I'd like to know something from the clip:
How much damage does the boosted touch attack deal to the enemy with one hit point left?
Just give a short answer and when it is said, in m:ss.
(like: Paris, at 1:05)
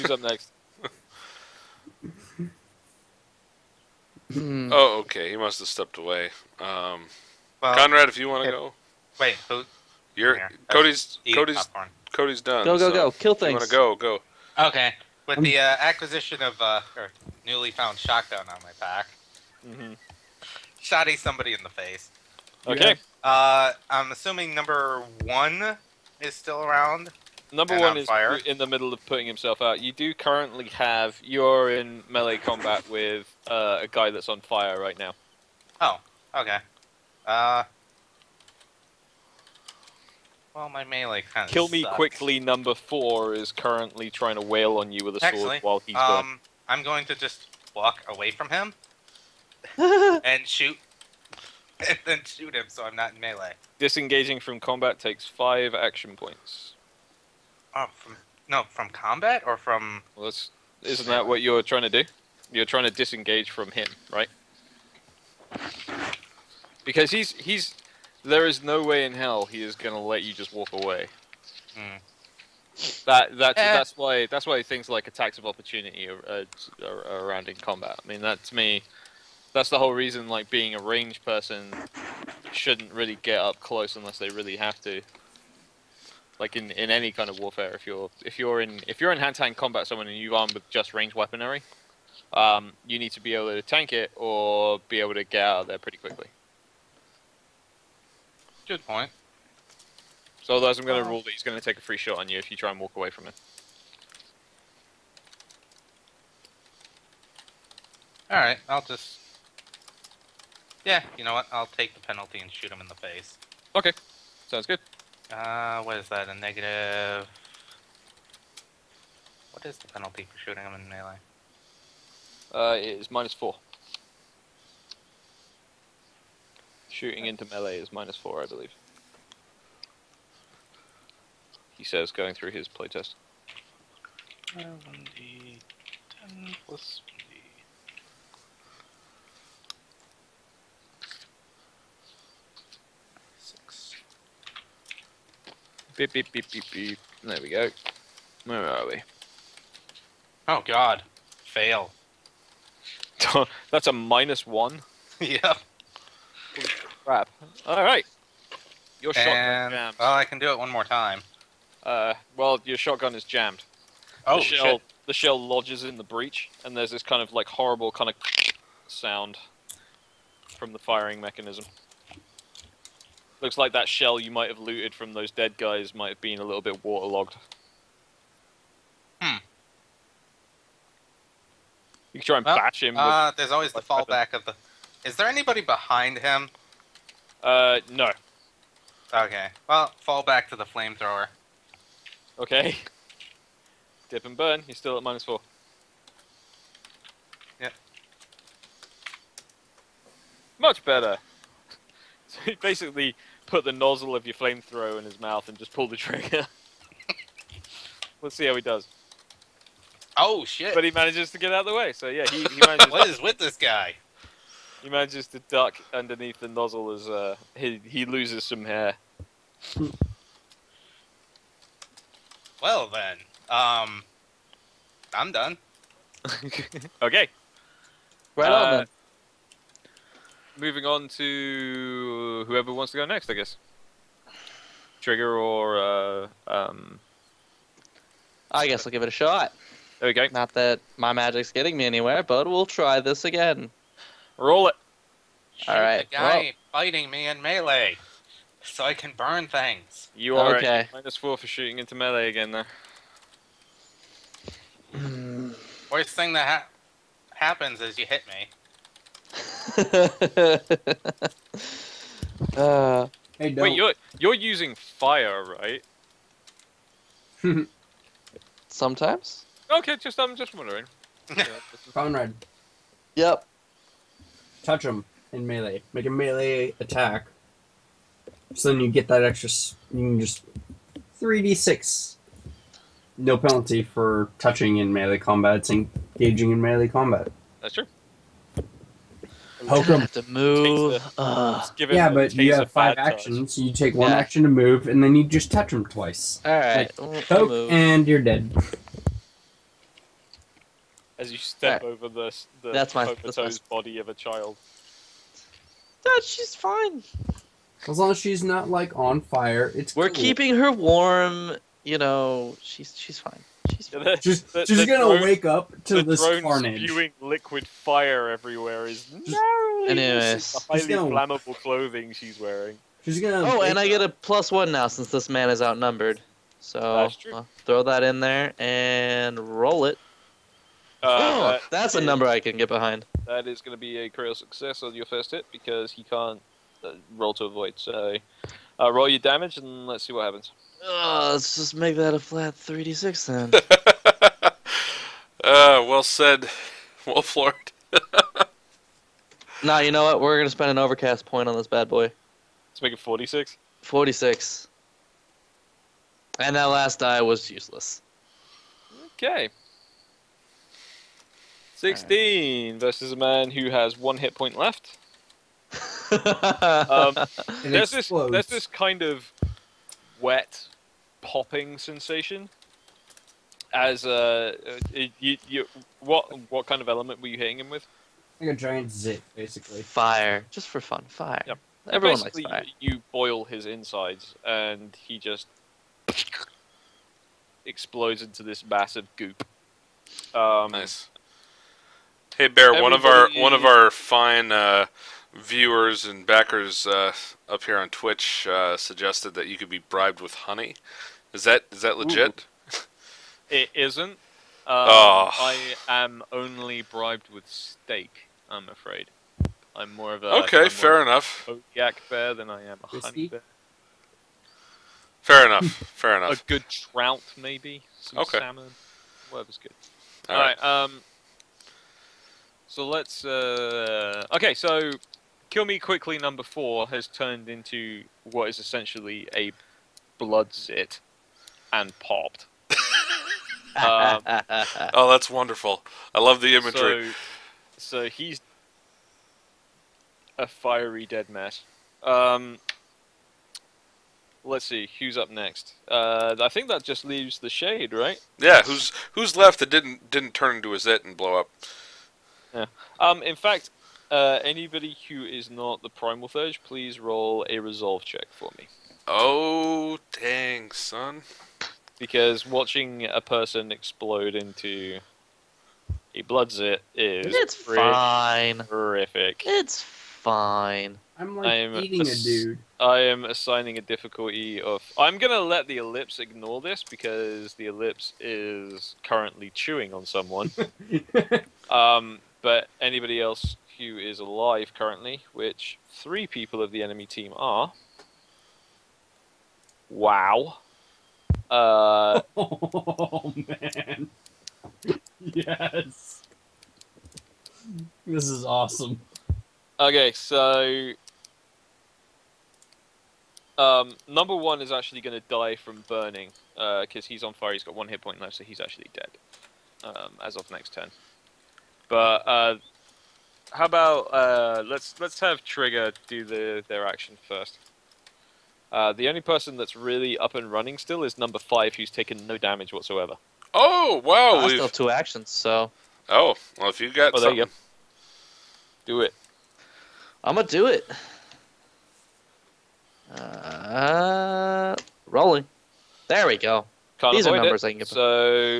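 16, at 6:01.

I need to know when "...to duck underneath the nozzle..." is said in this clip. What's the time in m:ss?
3:35.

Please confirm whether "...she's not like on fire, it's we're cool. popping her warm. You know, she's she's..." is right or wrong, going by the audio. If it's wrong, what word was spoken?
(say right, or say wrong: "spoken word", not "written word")
wrong: "keeping", not "popping".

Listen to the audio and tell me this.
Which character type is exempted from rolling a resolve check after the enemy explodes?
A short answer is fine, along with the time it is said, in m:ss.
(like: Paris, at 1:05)
primal thurge, at 7:35.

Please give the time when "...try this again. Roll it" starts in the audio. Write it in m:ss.
4:02.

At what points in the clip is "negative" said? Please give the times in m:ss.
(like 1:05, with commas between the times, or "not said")
1:56.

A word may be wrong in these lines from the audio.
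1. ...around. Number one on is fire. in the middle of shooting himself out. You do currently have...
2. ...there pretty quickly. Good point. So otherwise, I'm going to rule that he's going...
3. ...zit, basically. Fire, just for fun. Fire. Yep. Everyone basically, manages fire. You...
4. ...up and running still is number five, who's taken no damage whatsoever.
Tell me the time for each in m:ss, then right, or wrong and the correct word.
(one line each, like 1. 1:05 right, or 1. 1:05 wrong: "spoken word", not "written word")
1. 0:26 wrong: "putting", not "shooting"
2. 1:35 right
3. 6:18 wrong: "likes", not "manages"
4. 8:40 right.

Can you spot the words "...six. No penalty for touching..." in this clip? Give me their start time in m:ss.
4:41.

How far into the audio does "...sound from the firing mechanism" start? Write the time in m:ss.
2:48.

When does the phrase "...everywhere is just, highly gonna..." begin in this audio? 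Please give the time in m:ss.
5:18.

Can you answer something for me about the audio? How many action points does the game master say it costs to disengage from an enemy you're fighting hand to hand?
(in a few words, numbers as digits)
5.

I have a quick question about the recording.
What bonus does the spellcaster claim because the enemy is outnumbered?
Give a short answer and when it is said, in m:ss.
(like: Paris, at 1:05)
plus 1, at 5:24.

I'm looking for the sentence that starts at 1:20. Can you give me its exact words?
Like being a range person shouldn't really get up close unless they really have to.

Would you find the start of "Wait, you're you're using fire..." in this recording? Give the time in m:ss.
4:23.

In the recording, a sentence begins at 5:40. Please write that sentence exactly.
Uh, let's just make that a flat 3d6 then.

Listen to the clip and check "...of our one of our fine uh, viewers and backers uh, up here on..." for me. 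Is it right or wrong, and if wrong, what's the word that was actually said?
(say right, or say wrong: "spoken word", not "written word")
right.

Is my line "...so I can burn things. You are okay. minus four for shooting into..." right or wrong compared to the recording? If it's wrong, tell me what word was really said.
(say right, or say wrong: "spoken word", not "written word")
right.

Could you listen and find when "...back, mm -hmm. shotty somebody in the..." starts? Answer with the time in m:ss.
0:18.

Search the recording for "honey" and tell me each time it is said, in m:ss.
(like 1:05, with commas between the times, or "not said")
6:40, 6:53.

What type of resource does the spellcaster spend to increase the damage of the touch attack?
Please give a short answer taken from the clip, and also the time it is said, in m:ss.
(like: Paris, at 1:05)
overcast point, at 5:50.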